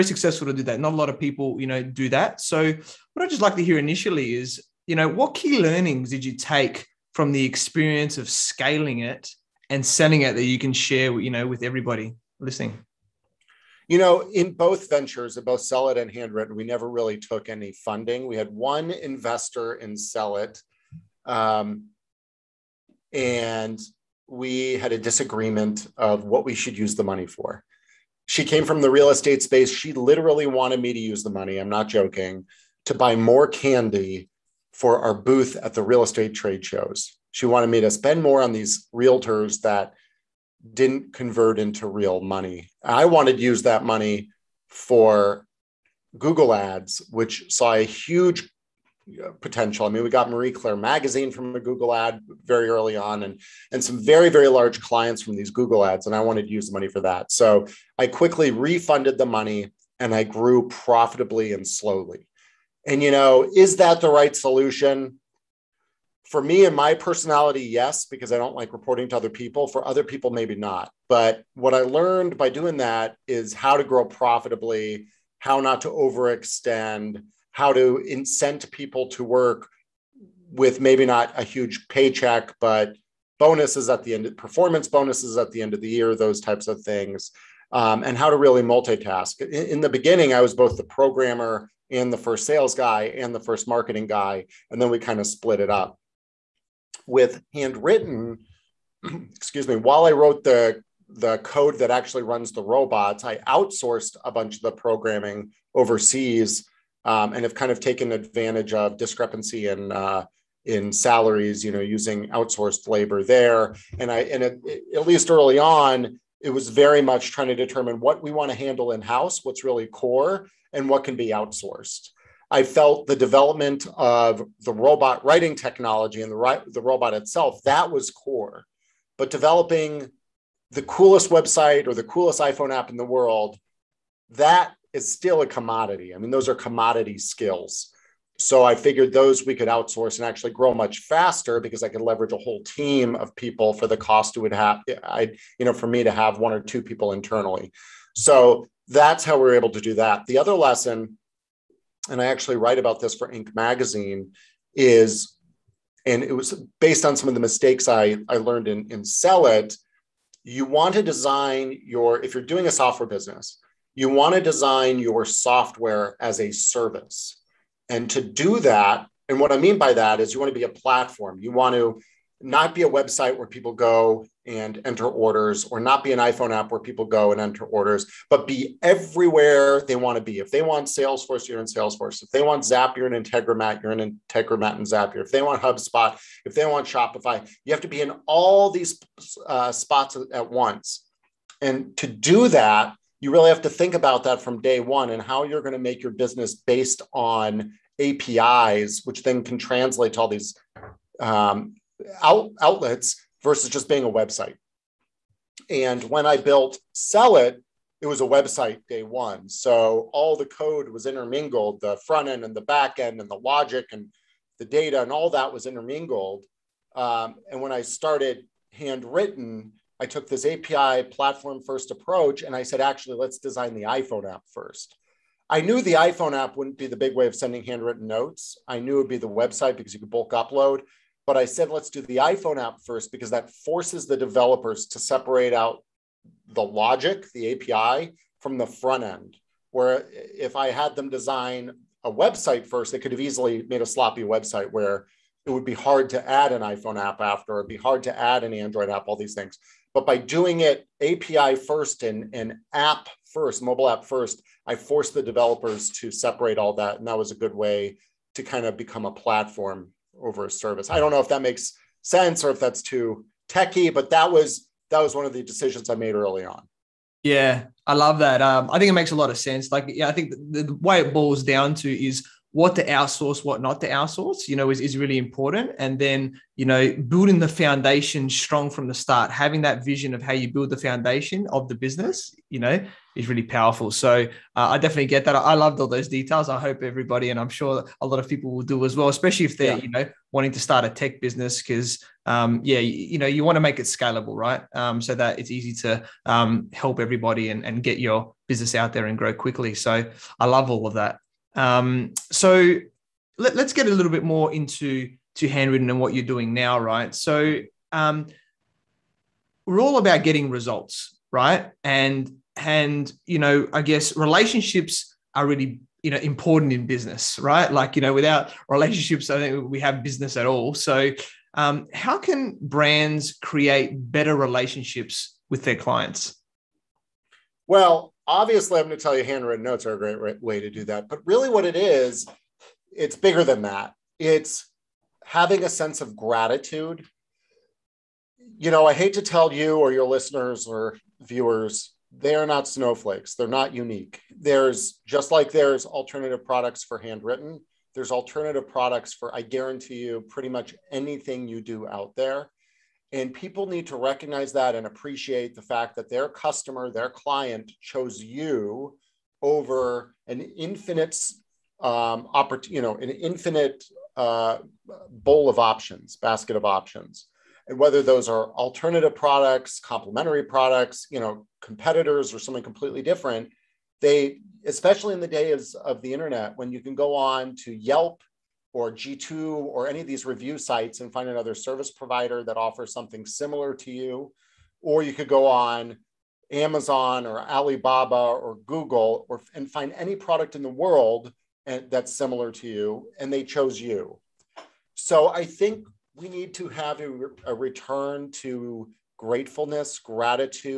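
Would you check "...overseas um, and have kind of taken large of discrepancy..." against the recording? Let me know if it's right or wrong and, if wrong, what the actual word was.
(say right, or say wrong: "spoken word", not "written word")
wrong: "advantage", not "large".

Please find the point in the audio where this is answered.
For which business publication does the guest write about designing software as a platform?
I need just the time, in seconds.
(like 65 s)
153 s.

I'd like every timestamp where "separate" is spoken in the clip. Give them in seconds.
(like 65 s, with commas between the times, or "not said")
234 s, 256 s.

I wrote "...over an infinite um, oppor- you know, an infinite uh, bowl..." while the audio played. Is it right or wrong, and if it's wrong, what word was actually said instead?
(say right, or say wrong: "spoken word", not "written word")
right.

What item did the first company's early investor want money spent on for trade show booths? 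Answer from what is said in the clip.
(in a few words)
Candy.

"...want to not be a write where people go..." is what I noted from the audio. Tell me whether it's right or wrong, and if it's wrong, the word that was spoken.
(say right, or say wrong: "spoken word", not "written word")
wrong: "website", not "write".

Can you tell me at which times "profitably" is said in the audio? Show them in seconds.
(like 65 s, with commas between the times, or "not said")
60 s, 74 s.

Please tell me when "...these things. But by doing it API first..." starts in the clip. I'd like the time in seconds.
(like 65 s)
249 s.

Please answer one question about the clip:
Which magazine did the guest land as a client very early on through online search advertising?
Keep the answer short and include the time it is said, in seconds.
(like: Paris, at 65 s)
Marie Claire, at 50 s.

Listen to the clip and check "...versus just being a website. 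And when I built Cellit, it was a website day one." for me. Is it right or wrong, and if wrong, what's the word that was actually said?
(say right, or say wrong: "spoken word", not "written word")
right.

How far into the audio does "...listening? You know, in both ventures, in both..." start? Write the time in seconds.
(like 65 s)
12 s.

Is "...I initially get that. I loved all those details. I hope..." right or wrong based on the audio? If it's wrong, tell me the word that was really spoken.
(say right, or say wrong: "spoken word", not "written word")
wrong: "definitely", not "initially".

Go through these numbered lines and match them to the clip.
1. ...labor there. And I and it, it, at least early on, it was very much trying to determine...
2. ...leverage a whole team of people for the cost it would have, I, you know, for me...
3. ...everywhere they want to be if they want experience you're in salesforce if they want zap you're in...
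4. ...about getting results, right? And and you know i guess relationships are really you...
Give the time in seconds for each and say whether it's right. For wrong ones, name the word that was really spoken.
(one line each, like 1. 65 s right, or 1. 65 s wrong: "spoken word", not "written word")
1. 112 s right
2. 141 s right
3. 178 s wrong: "salesforce", not "experience"
4. 309 s right.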